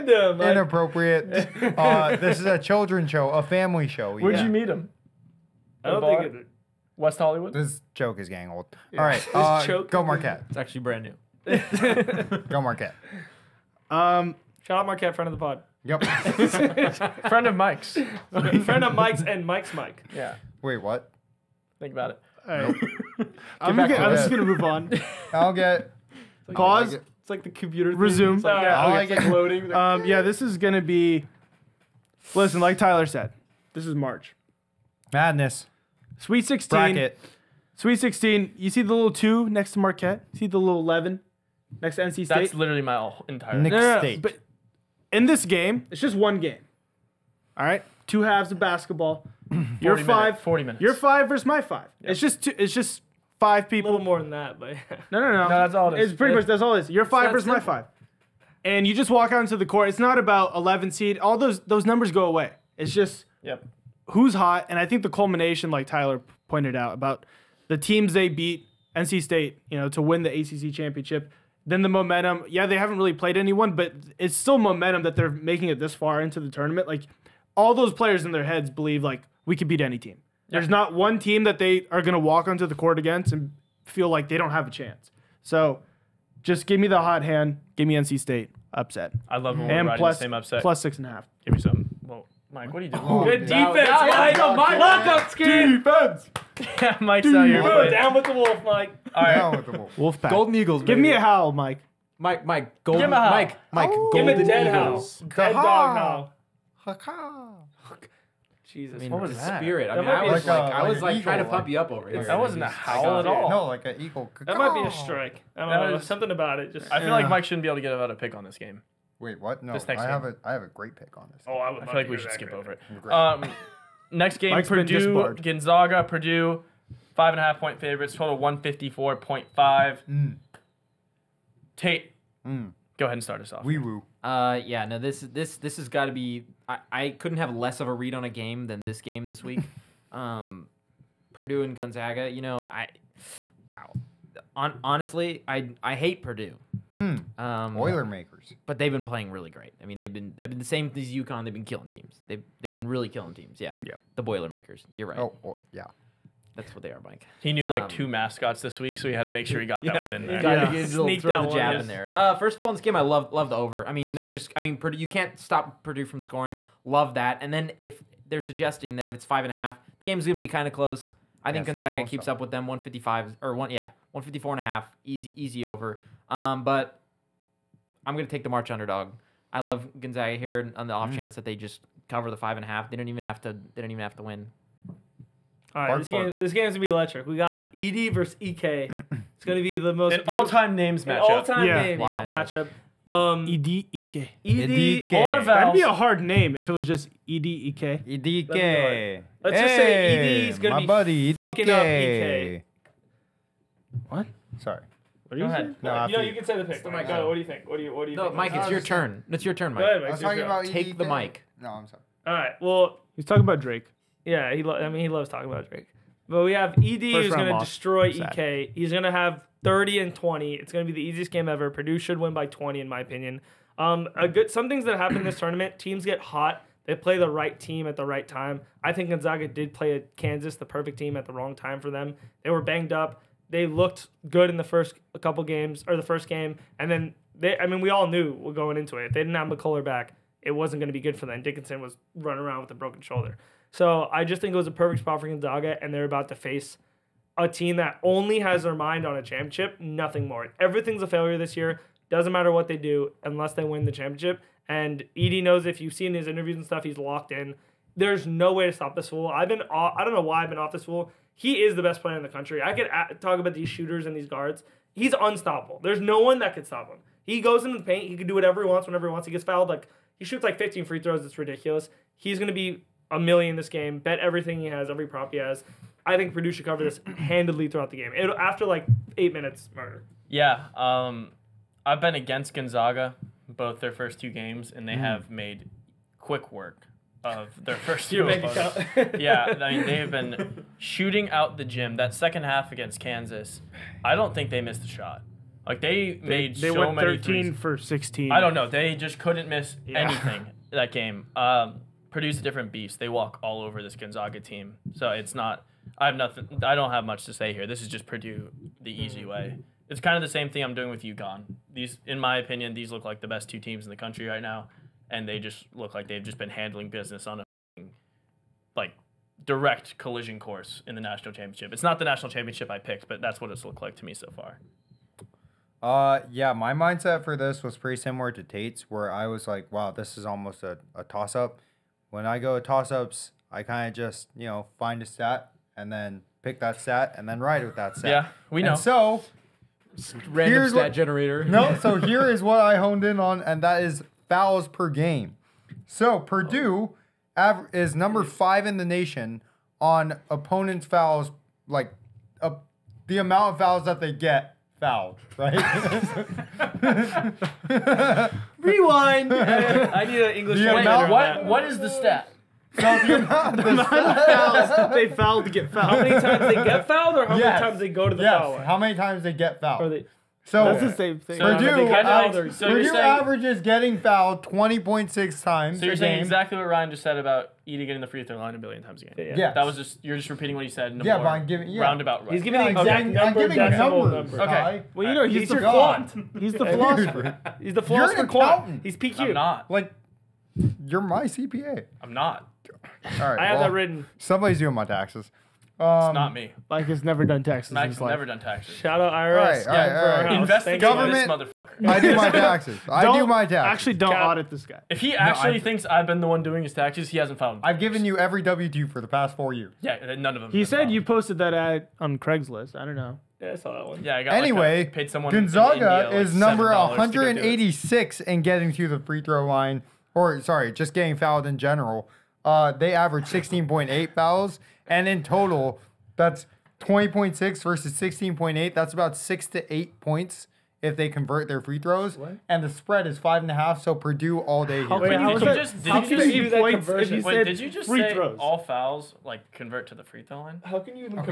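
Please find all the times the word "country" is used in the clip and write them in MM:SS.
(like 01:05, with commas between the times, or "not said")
04:22, 05:13.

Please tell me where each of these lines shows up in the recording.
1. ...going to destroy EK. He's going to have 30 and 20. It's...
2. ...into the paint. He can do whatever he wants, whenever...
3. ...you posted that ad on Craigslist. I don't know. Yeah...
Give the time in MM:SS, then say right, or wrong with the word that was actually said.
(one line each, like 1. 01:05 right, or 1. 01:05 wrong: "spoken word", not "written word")
1. 03:37 right
2. 04:27 right
3. 06:50 right.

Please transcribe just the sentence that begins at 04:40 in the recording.
Yeah, um, I've been against Gonzaga both their first two games, and they mm.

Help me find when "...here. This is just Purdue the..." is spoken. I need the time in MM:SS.
05:07.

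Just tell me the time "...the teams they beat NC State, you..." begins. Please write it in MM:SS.
01:07.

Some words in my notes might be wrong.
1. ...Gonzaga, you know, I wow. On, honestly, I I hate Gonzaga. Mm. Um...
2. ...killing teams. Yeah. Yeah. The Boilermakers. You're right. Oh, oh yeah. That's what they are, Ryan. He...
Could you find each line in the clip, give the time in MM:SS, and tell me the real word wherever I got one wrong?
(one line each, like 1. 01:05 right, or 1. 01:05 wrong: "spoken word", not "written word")
1. 02:21 wrong: "Purdue", not "Gonzaga"
2. 02:33 wrong: "Mike", not "Ryan".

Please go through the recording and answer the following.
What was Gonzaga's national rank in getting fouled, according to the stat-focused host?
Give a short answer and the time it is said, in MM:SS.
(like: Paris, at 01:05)
186, at 06:56.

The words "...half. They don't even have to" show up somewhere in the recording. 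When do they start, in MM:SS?
03:02.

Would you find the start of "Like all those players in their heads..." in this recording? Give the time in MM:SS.
01:16.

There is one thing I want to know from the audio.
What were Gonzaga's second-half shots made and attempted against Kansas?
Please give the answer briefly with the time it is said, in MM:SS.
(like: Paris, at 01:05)
13 for 16, at 04:57.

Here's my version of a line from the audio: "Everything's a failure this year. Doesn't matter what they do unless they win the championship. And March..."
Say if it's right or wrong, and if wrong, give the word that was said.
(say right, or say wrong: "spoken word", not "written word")
wrong: "Edey", not "March".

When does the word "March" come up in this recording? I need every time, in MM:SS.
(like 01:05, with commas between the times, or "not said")
00:33, 02:58.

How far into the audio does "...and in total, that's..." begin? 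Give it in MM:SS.
07:04.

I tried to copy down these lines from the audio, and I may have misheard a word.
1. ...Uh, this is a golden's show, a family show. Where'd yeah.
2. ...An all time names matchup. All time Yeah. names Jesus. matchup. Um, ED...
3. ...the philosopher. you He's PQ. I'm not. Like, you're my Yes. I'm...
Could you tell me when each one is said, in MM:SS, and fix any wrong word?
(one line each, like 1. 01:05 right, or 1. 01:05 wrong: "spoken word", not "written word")
1. 00:01 wrong: "children", not "golden"
2. 03:10 wrong: "Wow", not "Jesus"
3. 06:27 wrong: "CPA", not "Yes".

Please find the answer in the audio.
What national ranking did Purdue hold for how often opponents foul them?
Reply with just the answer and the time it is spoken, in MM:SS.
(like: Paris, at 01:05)
5, at 05:47.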